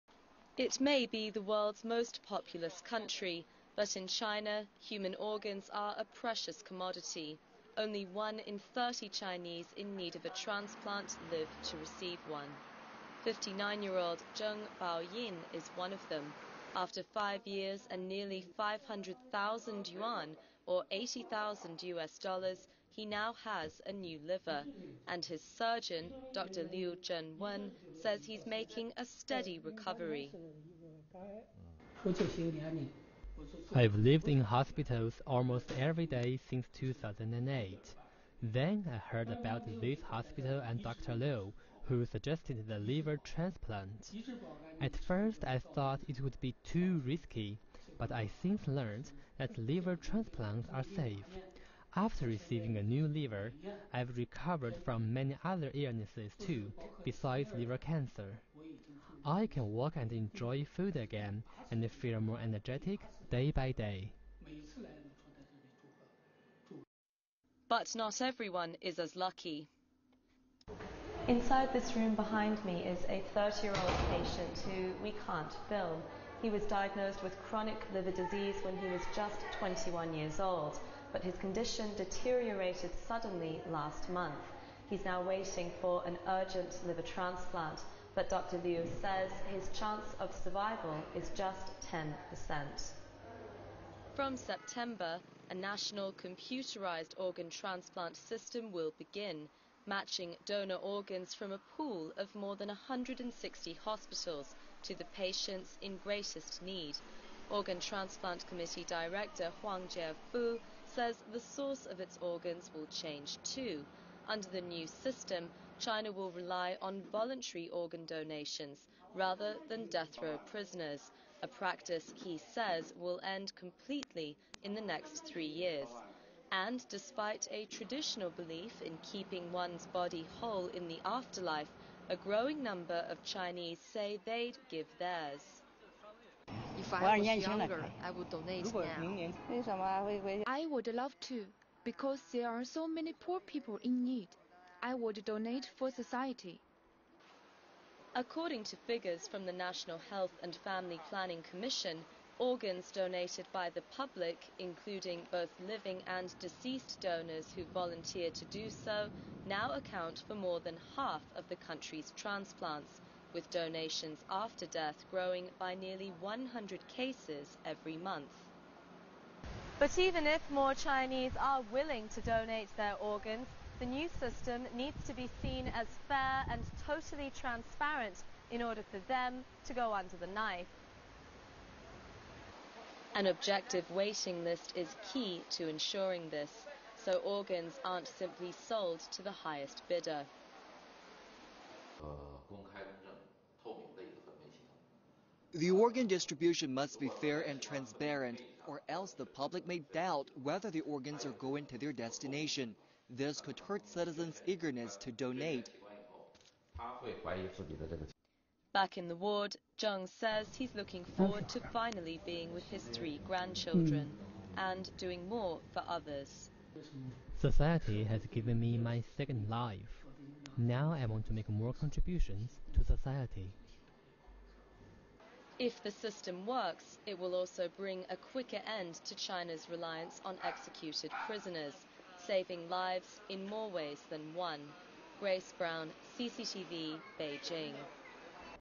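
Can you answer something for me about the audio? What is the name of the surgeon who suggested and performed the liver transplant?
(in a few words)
Liu Wen.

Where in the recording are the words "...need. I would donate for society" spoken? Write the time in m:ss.
2:24.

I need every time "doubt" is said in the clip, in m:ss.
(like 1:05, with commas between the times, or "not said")
3:19.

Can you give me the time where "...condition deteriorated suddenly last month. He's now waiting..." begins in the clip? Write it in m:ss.
1:21.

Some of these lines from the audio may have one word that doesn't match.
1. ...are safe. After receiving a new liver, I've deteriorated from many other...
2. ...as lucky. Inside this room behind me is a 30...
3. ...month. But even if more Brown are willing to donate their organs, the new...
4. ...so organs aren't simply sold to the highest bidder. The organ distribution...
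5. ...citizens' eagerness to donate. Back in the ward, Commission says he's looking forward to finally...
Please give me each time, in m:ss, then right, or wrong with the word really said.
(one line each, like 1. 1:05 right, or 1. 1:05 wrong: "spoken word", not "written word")
1. 0:50 wrong: "recovered", not "deteriorated"
2. 1:08 right
3. 2:47 wrong: "Chinese", not "Brown"
4. 3:06 right
5. 3:23 wrong: "Zheng", not "Commission".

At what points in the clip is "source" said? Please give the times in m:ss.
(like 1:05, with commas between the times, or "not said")
1:51.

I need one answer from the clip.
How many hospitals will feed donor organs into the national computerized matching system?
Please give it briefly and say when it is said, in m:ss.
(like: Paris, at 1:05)
more than 160, at 1:42.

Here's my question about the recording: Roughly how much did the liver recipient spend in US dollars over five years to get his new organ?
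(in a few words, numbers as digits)
$80,000.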